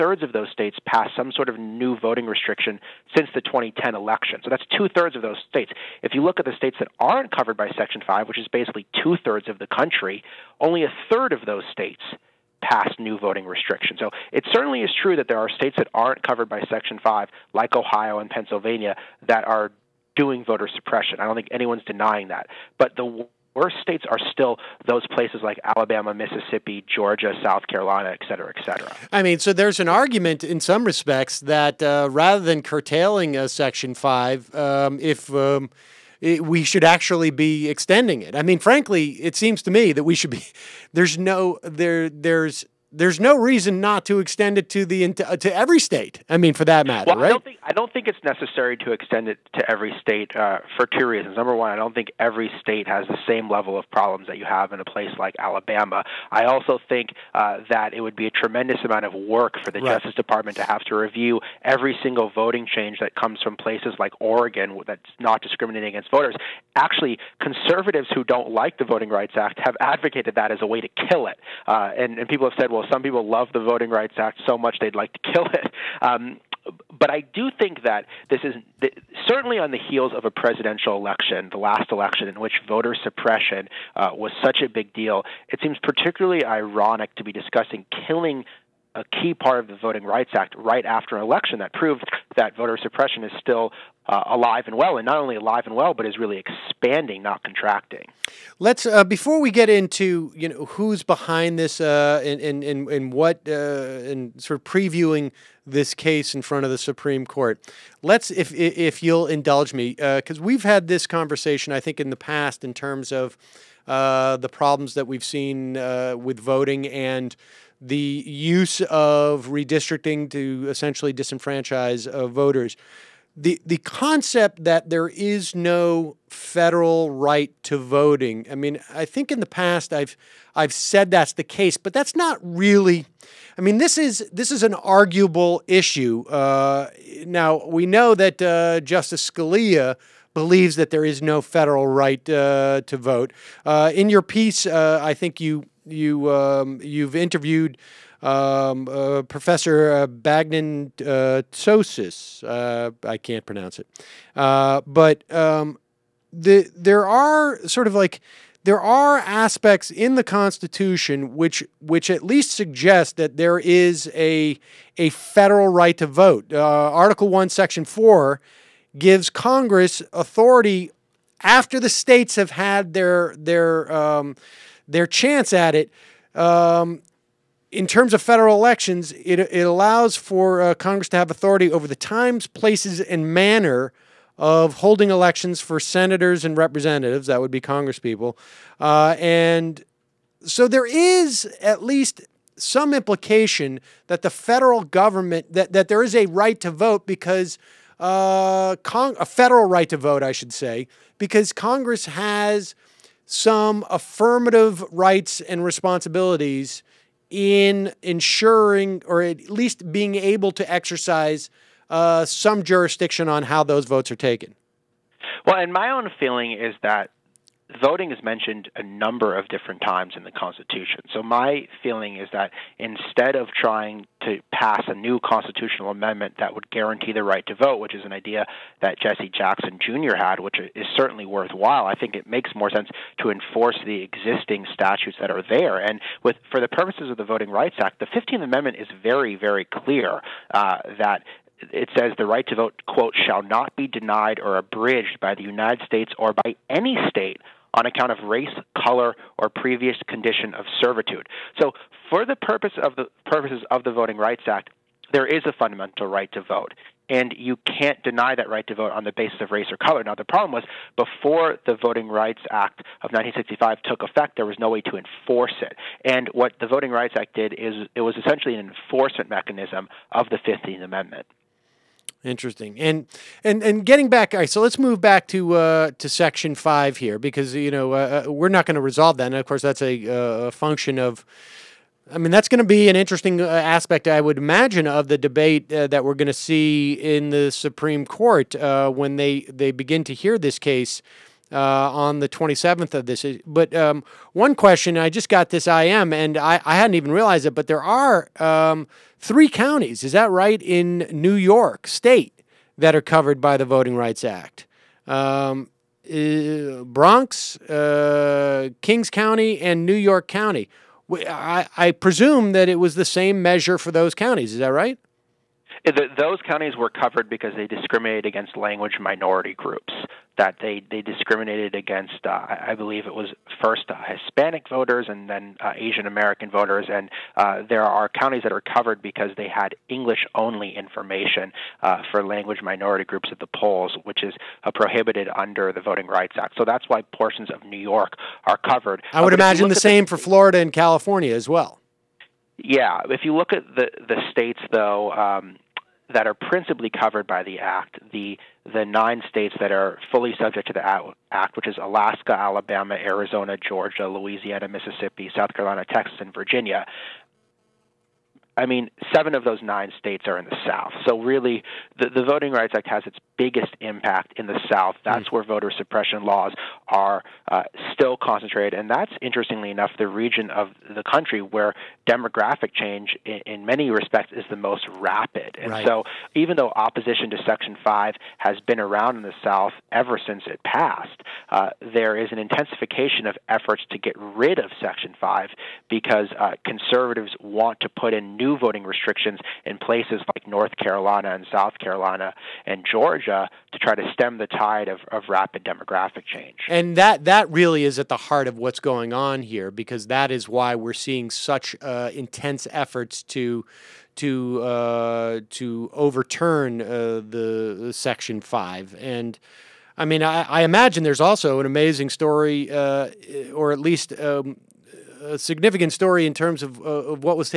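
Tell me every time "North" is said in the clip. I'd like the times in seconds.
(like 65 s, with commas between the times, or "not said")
390 s.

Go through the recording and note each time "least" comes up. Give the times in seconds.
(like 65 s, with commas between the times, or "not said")
162 s, 191 s, 209 s, 413 s.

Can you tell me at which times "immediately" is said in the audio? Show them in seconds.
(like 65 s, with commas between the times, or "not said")
not said.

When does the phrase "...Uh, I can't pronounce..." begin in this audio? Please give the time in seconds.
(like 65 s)
152 s.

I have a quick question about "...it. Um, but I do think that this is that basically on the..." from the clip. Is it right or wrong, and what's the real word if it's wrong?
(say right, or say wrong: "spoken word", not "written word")
wrong: "certainly", not "basically".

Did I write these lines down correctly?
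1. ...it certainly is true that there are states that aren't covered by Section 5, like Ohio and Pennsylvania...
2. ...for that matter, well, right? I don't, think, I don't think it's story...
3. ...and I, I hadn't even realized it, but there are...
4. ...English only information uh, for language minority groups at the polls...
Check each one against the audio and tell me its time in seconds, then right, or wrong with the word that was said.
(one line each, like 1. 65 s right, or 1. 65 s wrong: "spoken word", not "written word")
1. 14 s right
2. 46 s wrong: "necessary", not "story"
3. 296 s right
4. 329 s right.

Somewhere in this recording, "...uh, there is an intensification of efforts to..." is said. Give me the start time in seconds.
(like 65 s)
381 s.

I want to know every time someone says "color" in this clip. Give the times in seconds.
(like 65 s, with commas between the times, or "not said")
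248 s, 259 s.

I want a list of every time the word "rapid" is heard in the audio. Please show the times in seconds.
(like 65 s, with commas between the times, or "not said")
374 s, 395 s.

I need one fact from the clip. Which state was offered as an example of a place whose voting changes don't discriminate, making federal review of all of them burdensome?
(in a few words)
Oregon.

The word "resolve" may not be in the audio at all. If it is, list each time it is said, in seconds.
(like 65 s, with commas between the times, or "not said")
278 s.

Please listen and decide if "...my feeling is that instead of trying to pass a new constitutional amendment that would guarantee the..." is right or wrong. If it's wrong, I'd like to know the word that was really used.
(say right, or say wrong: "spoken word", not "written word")
right.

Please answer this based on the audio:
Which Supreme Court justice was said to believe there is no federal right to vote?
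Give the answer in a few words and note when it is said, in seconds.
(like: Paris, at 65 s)
Justice Scalia, at 138 s.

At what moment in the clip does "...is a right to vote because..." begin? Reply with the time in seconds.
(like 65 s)
196 s.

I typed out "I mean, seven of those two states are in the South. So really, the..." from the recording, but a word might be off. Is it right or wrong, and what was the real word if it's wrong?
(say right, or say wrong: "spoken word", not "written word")
wrong: "nine", not "two".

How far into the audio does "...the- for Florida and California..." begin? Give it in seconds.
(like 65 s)
340 s.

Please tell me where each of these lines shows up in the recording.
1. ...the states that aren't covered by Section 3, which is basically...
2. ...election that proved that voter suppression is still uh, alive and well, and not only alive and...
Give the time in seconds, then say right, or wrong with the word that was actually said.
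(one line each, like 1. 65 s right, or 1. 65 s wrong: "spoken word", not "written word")
1. 6 s wrong: "5", not "3"
2. 91 s right.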